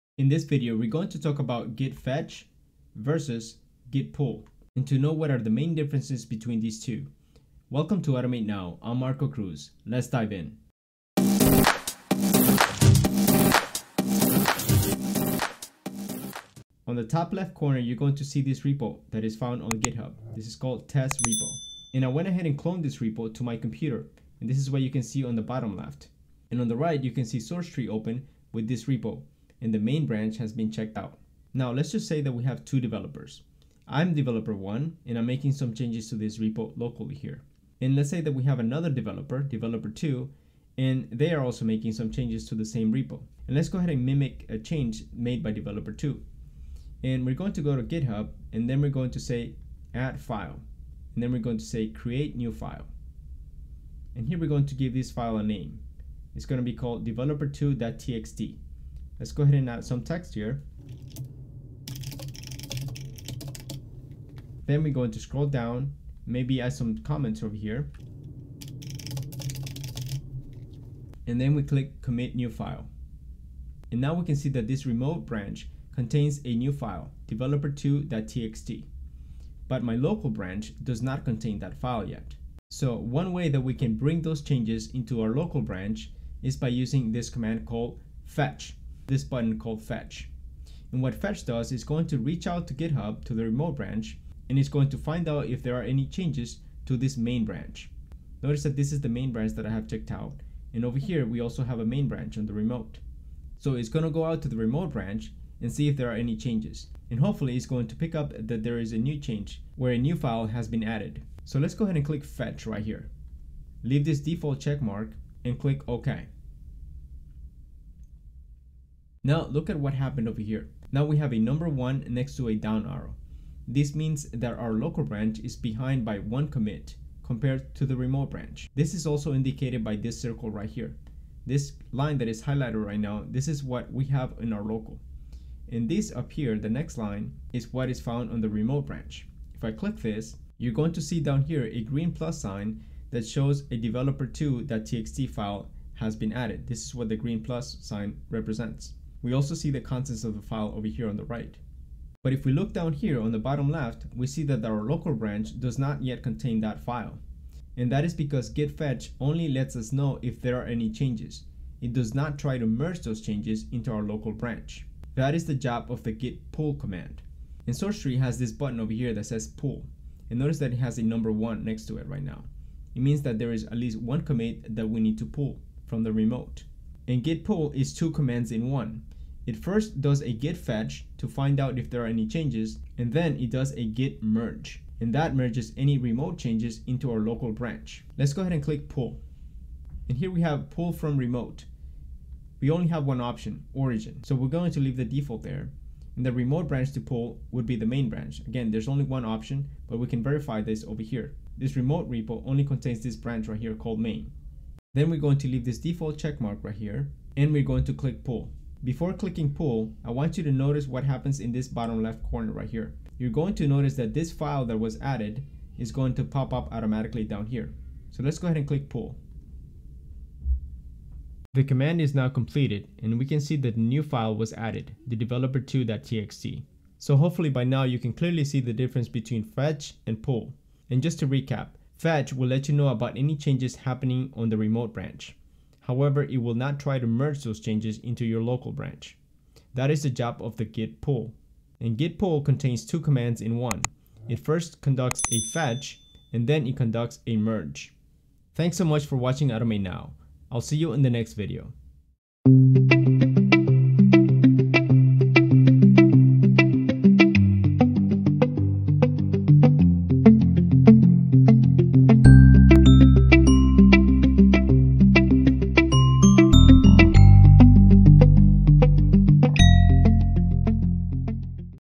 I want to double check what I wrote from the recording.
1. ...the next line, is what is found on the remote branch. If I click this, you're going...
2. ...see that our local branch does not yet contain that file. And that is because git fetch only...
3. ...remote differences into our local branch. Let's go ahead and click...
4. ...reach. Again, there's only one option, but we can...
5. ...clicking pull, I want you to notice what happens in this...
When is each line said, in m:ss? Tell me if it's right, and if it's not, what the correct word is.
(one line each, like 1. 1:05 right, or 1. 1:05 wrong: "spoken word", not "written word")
1. 2:16 right
2. 2:34 right
3. 3:05 wrong: "changes", not "differences"
4. 3:18 wrong: "branch", not "reach"
5. 3:29 right.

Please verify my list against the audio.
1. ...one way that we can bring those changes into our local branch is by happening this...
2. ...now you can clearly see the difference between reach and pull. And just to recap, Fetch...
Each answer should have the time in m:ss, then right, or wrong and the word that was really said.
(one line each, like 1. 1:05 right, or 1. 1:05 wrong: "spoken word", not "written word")
1. 1:22 wrong: "using", not "happening"
2. 3:47 wrong: "fetch", not "reach".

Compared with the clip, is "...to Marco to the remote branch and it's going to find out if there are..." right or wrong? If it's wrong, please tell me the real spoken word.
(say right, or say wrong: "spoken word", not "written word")
wrong: "GitHub", not "Marco".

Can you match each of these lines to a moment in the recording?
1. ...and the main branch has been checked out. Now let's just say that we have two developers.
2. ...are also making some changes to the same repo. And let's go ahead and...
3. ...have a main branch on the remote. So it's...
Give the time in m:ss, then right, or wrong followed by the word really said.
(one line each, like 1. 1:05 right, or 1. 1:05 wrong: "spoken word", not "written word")
1. 0:29 right
2. 0:41 right
3. 1:41 right.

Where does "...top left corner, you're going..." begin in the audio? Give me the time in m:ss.
0:17.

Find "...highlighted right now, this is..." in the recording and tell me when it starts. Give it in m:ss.
2:12.